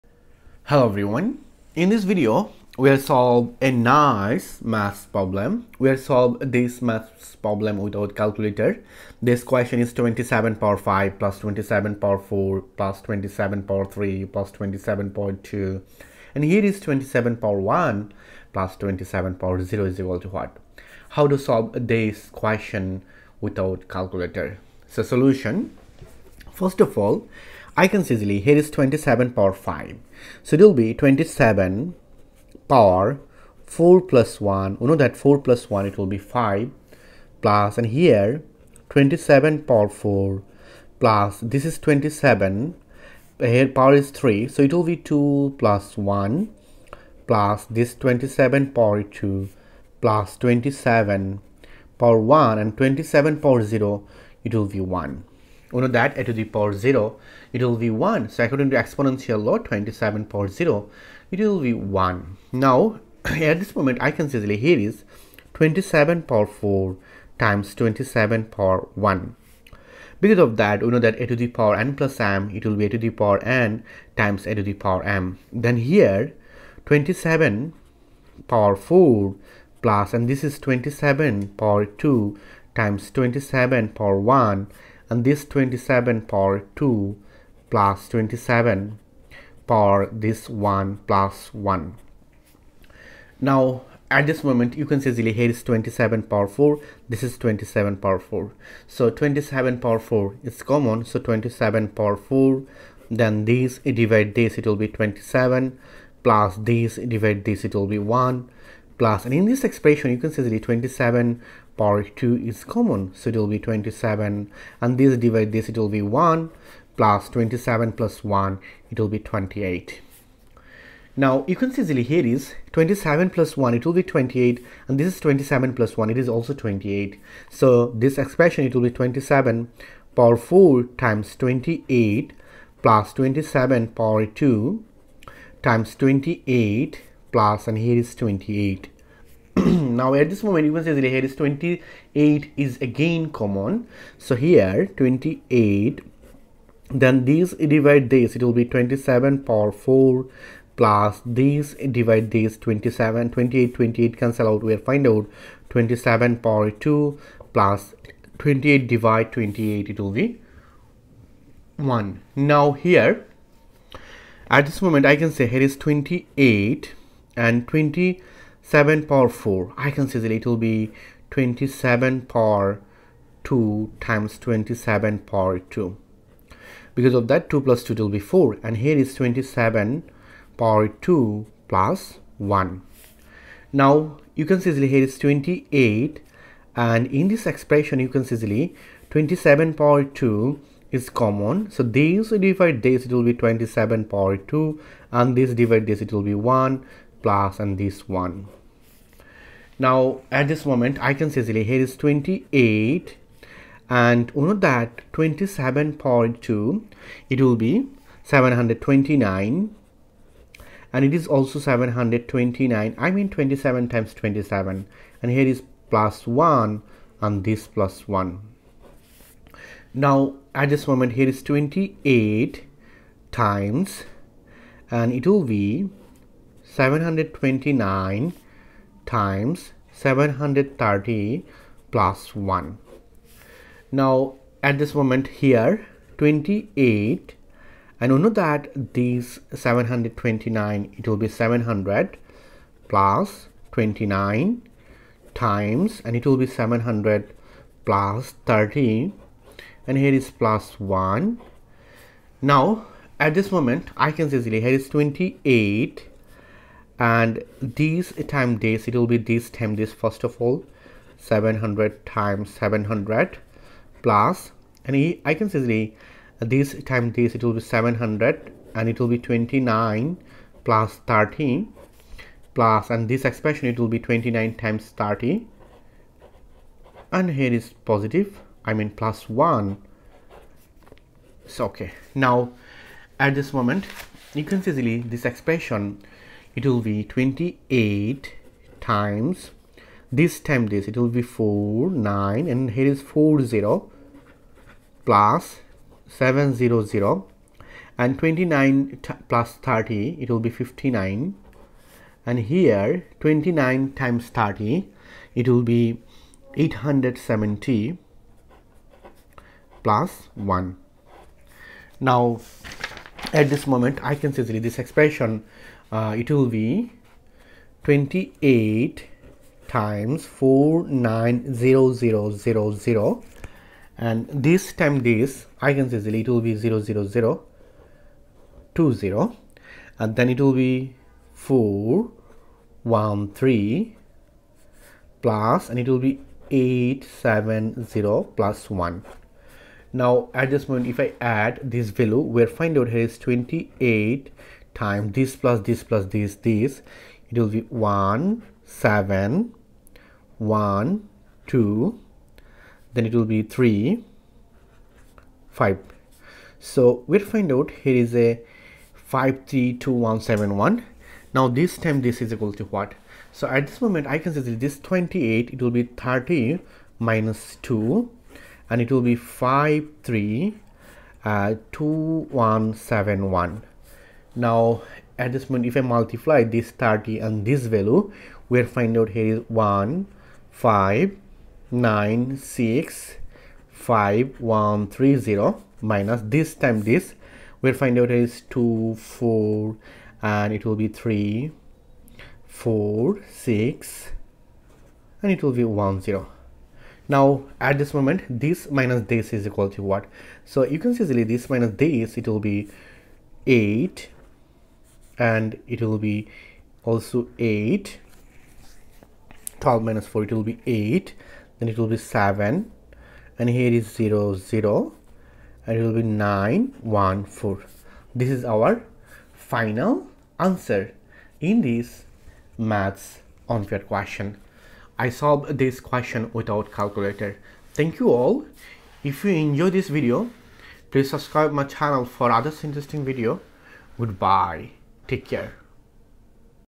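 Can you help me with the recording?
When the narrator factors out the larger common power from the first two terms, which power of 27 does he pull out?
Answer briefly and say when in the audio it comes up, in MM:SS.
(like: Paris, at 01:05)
27^4, at 01:39.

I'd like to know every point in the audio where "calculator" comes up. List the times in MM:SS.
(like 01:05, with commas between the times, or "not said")
00:08, 00:23, 07:06.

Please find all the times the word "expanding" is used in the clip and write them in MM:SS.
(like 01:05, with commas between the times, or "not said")
not said.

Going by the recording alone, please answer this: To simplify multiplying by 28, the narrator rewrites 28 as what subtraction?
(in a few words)
30 minus 2.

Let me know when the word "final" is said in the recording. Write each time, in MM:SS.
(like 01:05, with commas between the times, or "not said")
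06:59.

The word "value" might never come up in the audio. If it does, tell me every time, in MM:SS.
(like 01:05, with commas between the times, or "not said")
05:41, 06:17.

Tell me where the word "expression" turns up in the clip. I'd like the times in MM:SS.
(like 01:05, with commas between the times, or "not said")
01:49, 02:08, 03:07, 04:33, 04:45, 05:14.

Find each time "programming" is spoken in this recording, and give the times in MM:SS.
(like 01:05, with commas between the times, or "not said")
not said.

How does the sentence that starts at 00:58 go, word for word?
So according to exponential law 27 power 0, it will be 1.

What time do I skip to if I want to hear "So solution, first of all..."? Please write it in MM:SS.
00:24.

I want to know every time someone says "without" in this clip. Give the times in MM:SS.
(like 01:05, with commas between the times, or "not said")
00:07, 00:23, 07:06.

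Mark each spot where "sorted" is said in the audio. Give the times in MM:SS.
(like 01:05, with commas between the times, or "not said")
not said.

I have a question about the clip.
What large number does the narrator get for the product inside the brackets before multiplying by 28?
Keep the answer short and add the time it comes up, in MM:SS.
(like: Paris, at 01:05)
532171, at 05:58.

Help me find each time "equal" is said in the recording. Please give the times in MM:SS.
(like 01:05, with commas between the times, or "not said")
00:19, 06:02, 06:39.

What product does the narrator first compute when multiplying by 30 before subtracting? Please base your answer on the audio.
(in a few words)
15965130.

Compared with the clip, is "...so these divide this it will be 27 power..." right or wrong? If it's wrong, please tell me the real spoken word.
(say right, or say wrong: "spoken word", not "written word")
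right.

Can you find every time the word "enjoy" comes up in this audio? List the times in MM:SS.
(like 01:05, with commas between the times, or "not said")
07:09.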